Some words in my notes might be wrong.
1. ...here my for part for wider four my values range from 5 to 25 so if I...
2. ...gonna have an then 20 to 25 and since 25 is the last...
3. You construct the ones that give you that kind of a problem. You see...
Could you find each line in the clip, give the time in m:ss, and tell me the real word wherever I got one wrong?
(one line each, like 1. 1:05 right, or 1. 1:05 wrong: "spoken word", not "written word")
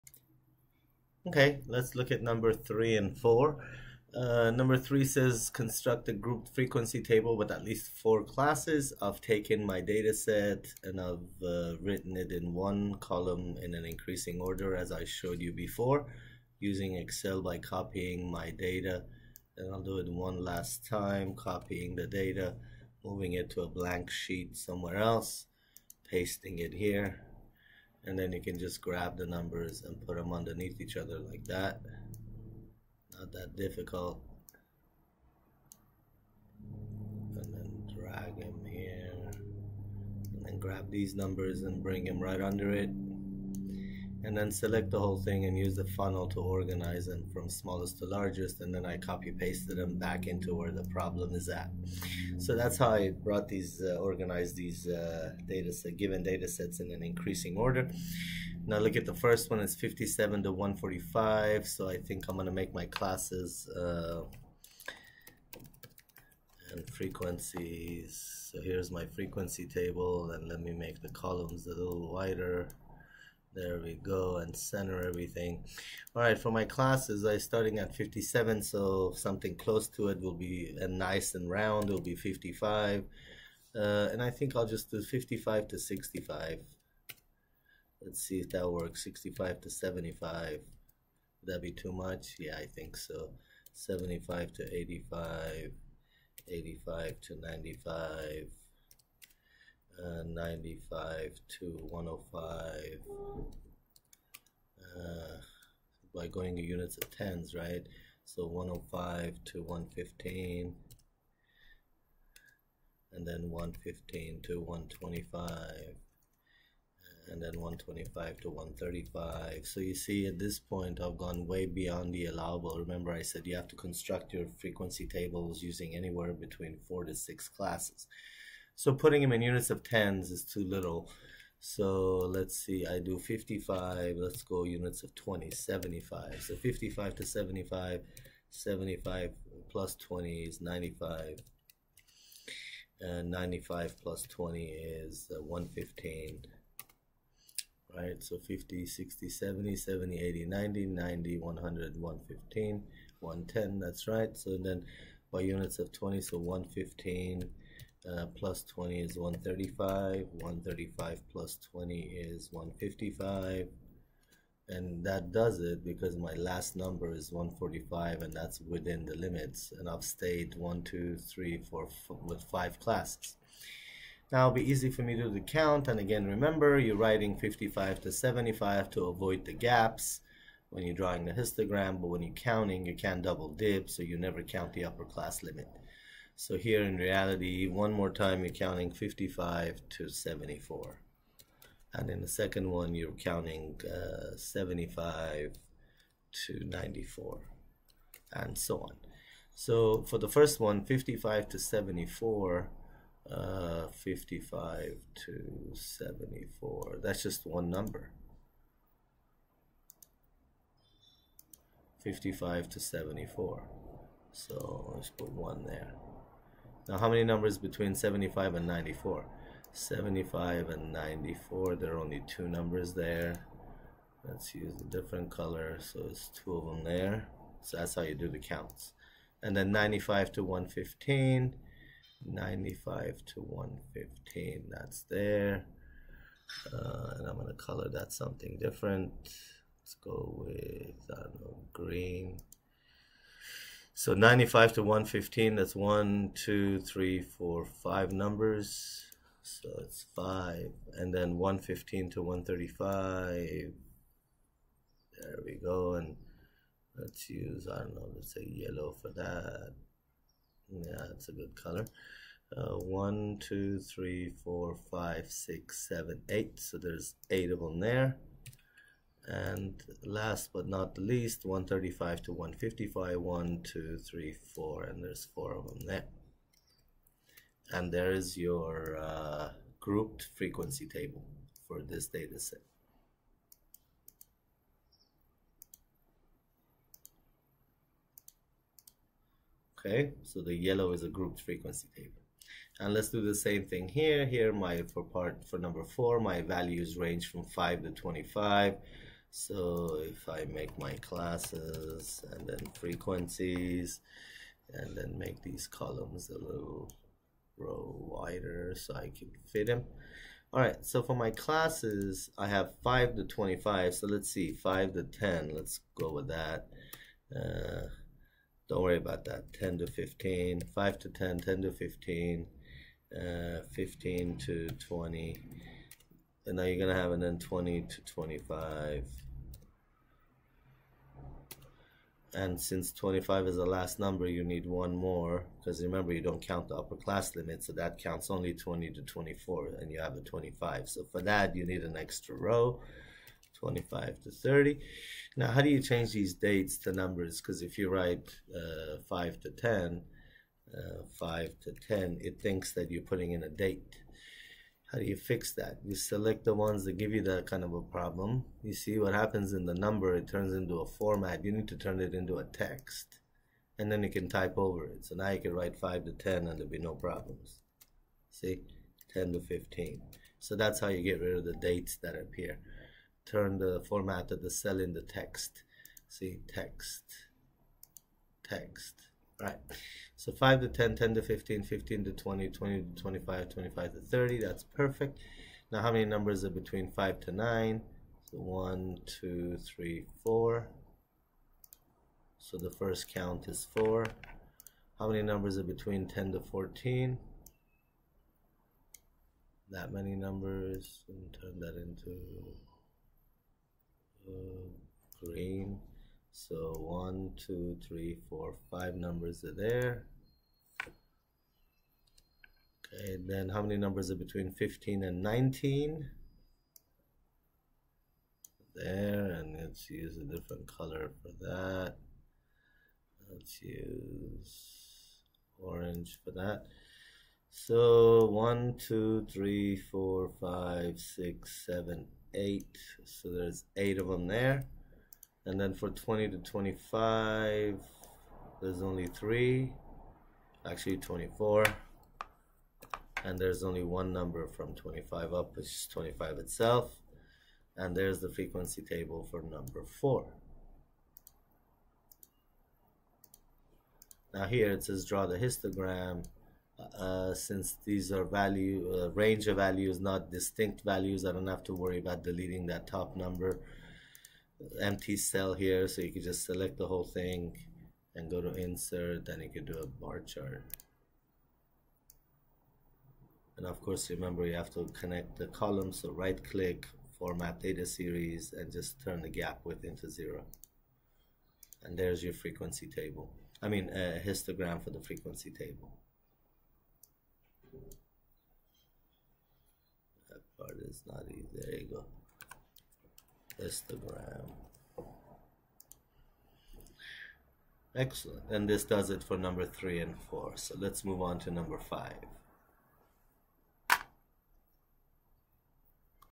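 1. 4:54 wrong: "number", not "wider"
2. 5:26 right
3. 5:55 wrong: "select", not "construct".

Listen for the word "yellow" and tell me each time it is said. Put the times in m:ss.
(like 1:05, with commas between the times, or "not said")
4:18, 4:50.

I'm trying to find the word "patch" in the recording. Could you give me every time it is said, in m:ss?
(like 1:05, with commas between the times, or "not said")
not said.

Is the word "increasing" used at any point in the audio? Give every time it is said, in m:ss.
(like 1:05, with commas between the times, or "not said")
0:13, 0:57.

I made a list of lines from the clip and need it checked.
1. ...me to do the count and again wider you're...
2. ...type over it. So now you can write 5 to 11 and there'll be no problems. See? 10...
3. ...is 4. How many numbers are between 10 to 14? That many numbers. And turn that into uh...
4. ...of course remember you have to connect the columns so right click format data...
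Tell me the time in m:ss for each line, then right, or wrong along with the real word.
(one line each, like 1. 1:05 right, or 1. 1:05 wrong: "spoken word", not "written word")
1. 2:55 wrong: "remember", not "wider"
2. 6:04 wrong: "10", not "11"
3. 6:33 right
4. 7:53 right.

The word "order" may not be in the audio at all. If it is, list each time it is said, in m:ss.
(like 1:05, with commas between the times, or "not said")
0:14, 0:57.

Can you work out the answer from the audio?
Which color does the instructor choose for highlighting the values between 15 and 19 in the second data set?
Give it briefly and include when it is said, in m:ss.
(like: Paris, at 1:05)
orange, at 7:05.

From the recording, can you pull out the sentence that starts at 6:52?
Okay, then how many numbers are between 15 and 19?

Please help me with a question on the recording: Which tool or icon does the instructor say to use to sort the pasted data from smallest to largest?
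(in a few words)
the funnel.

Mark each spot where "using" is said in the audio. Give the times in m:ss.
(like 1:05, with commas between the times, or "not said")
0:16, 2:05.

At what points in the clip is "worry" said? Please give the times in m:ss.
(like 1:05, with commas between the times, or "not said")
5:18, 7:41.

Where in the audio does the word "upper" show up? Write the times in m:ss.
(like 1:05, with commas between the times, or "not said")
3:04, 5:36.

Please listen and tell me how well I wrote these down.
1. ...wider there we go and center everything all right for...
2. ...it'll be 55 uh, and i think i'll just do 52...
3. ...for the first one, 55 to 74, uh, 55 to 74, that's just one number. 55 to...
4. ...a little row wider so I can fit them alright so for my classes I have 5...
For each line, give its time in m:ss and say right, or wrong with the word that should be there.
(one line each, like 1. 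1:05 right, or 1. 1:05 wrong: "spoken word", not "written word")
1. 1:12 right
2. 1:21 wrong: "55", not "52"
3. 3:20 right
4. 5:06 right.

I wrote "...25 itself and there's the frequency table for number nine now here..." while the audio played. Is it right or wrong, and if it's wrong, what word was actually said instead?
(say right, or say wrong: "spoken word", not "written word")
wrong: "four", not "nine".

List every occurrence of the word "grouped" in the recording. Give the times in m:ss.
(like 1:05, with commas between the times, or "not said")
0:06, 4:39, 4:51.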